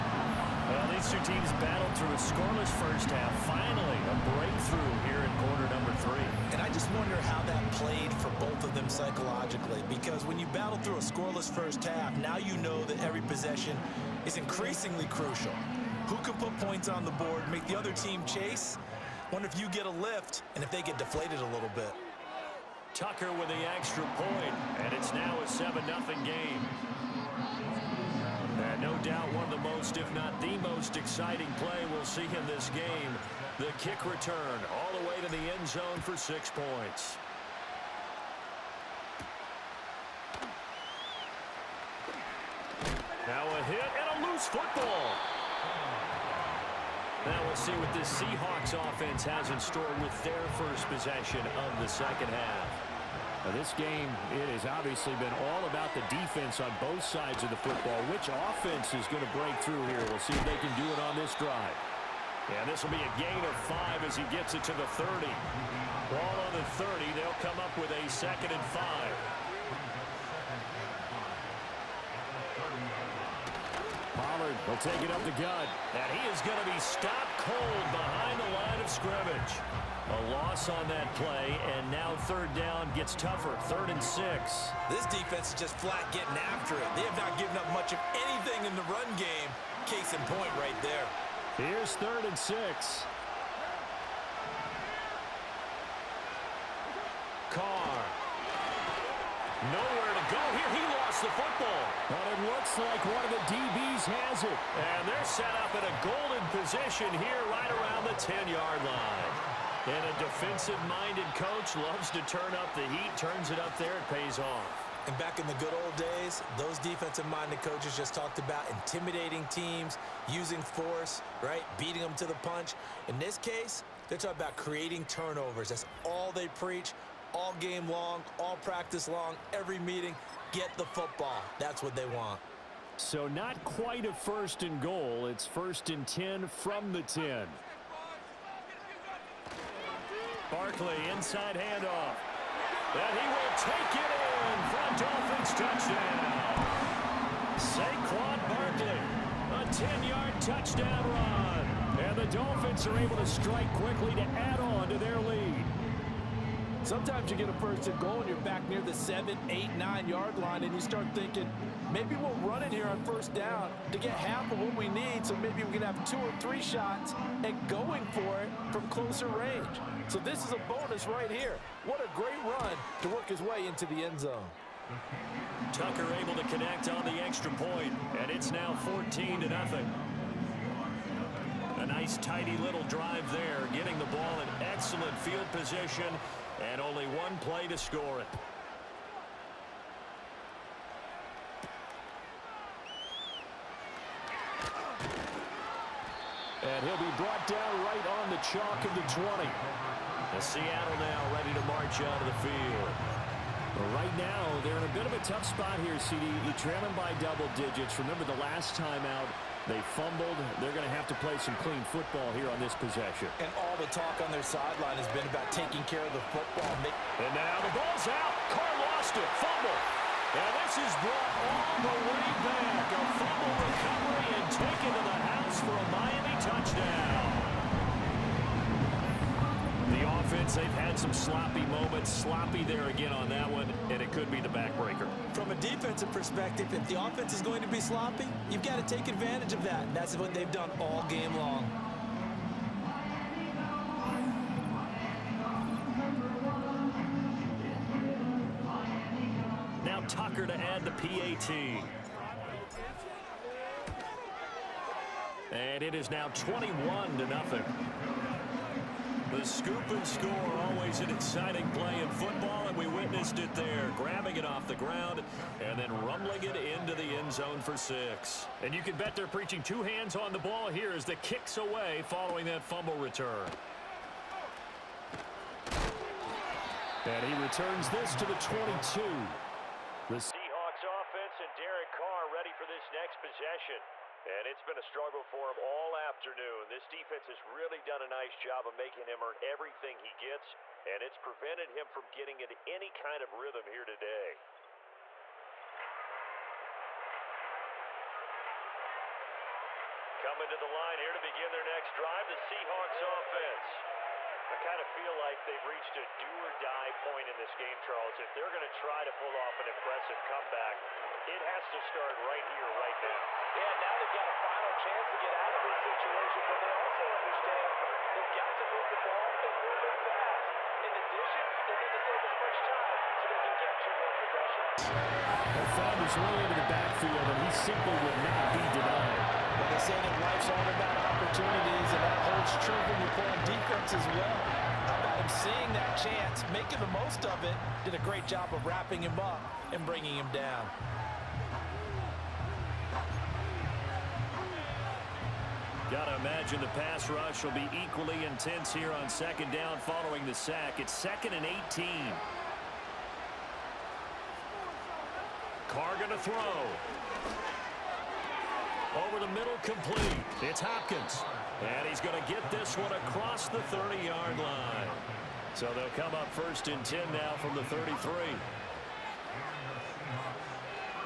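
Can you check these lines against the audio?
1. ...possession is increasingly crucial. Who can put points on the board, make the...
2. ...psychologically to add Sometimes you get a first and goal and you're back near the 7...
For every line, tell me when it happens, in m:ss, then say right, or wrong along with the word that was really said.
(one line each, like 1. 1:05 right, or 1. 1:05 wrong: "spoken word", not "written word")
1. 0:13 right
2. 2:33 wrong: "quickly", not "psychologically".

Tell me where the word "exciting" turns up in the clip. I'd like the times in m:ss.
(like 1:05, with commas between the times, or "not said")
0:30, 4:21.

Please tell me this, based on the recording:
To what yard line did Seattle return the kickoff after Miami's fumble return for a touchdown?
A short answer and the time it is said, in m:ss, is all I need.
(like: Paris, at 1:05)
22, at 4:38.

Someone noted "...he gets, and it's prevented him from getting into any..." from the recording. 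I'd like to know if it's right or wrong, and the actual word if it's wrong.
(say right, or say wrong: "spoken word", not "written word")
right.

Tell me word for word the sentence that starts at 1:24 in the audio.
This defense is just flat getting after it.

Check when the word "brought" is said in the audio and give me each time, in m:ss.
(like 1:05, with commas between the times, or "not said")
3:17, 3:41.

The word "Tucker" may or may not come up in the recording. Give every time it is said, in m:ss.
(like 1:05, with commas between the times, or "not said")
0:22, 2:55, 4:10.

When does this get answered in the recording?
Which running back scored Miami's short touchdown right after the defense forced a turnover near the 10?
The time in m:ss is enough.
2:27.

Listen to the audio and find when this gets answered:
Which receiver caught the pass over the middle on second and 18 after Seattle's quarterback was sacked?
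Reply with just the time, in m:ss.
6:00.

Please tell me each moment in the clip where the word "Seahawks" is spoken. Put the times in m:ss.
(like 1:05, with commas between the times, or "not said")
0:48, 4:40, 5:02.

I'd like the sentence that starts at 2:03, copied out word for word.
In this case, they're talking about creating turnovers.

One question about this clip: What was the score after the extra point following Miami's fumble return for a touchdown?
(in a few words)
21-0.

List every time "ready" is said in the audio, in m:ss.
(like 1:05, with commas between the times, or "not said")
3:21, 4:42.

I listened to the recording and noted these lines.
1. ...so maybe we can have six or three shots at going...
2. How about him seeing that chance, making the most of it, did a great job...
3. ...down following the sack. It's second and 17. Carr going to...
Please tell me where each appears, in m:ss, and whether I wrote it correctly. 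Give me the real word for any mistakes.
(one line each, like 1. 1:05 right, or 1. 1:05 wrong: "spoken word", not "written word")
1. 2:45 wrong: "two", not "six"
2. 5:34 right
3. 5:49 wrong: "18", not "17".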